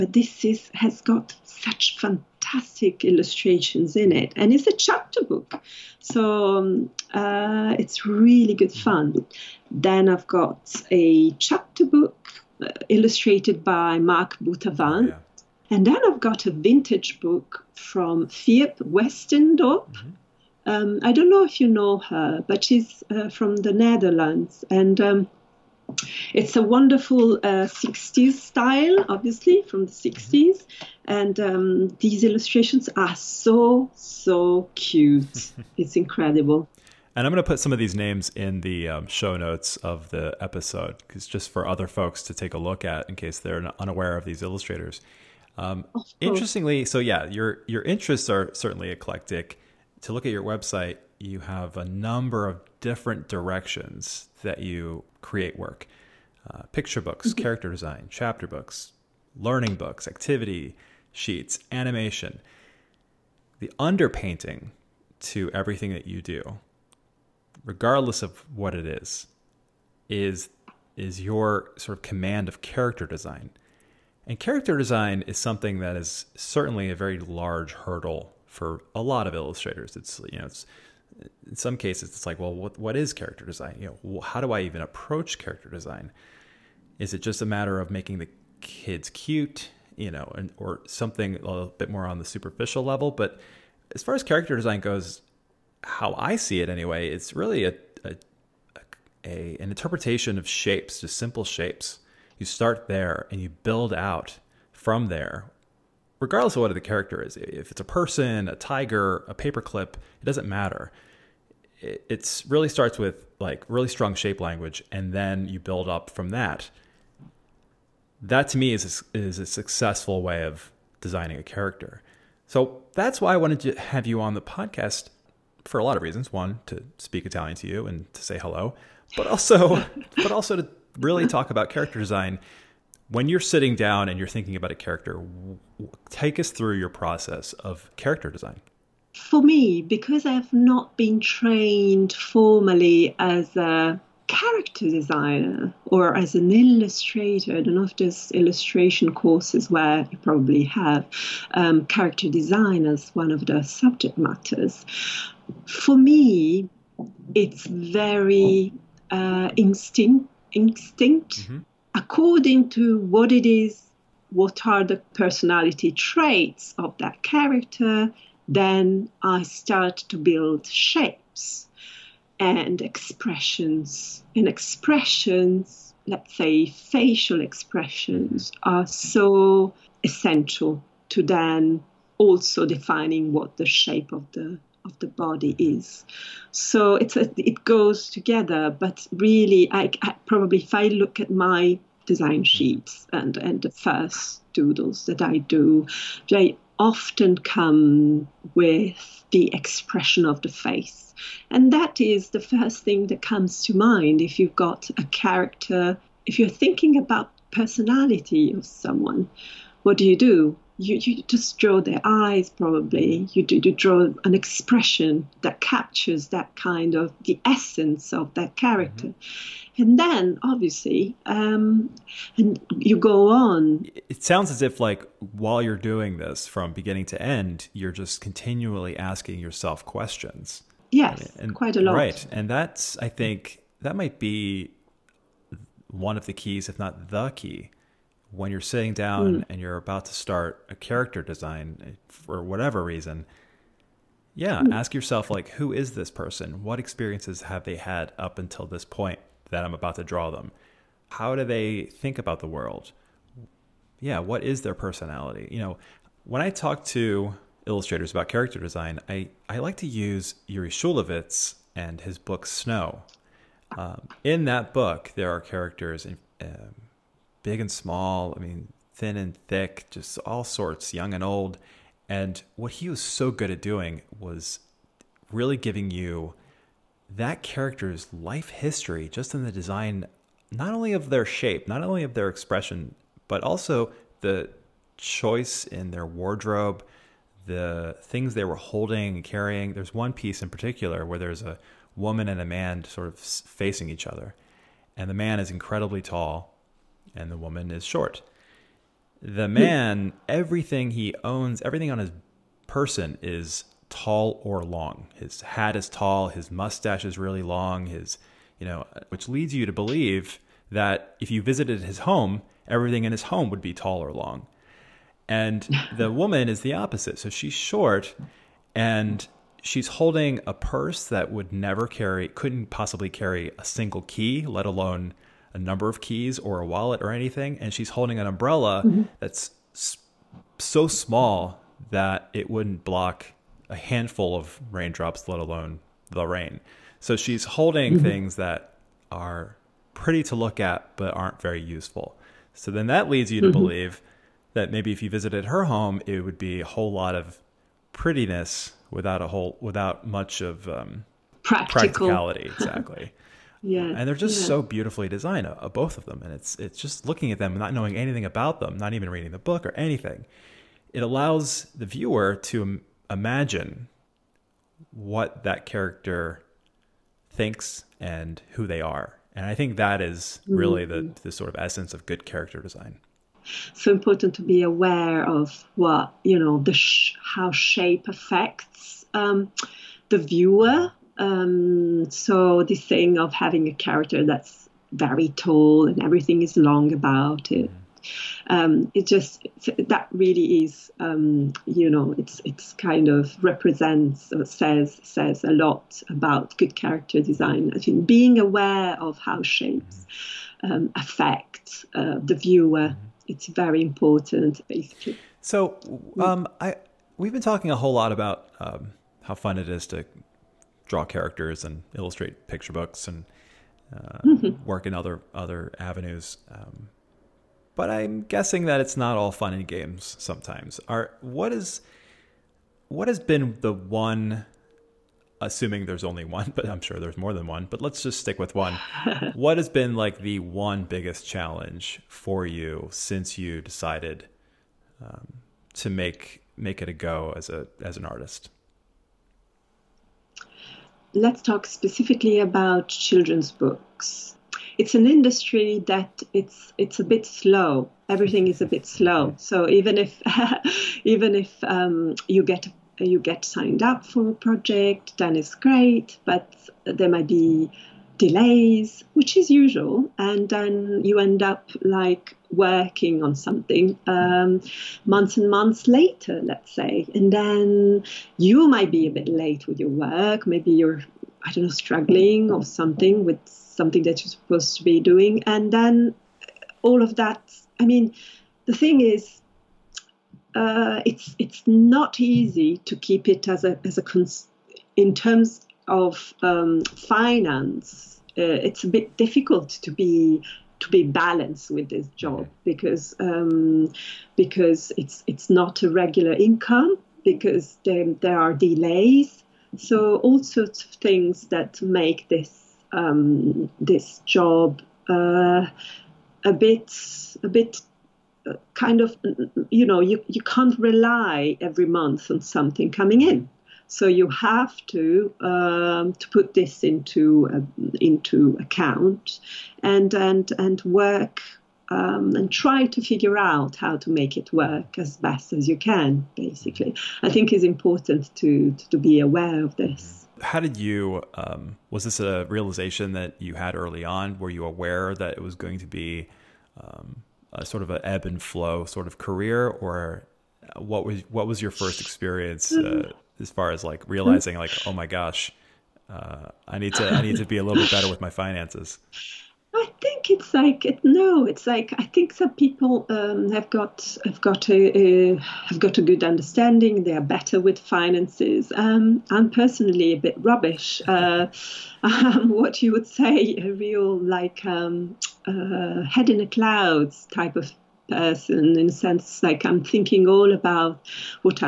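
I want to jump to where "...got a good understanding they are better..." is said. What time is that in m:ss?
9:15.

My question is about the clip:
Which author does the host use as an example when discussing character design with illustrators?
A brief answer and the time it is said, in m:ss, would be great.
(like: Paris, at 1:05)
Yuri Shulevitz, at 4:20.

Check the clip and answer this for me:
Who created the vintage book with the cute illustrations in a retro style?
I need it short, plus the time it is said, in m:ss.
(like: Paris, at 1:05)
Fiep Westendorp, at 0:18.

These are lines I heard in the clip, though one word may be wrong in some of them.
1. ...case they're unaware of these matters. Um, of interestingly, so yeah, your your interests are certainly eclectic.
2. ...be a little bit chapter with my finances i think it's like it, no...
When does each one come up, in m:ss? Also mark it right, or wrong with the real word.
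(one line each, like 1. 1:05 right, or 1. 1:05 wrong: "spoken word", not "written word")
1. 0:43 wrong: "illustrators", not "matters"
2. 9:07 wrong: "better", not "chapter".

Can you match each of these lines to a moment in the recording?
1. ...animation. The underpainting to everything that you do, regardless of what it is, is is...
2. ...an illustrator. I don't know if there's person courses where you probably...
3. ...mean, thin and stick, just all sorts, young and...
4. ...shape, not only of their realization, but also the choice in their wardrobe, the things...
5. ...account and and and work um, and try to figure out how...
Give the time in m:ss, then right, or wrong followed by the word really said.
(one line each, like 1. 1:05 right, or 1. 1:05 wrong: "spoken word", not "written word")
1. 1:01 right
2. 2:26 wrong: "illustration", not "person"
3. 4:28 wrong: "thick", not "stick"
4. 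4:41 wrong: "expression", not "realization"
5. 8:38 right.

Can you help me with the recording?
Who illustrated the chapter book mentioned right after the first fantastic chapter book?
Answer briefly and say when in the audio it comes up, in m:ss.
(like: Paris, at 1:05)
Marc Boutavant, at 0:13.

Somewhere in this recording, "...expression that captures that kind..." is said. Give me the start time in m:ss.
3:34.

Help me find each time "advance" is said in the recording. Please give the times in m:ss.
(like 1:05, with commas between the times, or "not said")
not said.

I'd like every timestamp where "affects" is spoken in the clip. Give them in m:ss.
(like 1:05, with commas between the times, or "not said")
6:18, 6:40.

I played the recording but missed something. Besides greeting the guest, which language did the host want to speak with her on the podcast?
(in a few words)
Italian.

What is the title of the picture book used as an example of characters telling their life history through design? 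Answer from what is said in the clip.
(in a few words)
Snow.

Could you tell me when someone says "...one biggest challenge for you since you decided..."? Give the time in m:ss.
7:10.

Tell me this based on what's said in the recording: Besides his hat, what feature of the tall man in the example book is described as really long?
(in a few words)
mustache.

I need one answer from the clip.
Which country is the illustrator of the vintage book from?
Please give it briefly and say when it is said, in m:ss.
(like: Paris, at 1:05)
Netherlands, at 0:23.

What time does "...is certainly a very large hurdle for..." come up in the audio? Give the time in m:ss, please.
1:15.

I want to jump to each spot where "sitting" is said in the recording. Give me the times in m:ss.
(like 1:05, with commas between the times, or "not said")
2:13, 3:58.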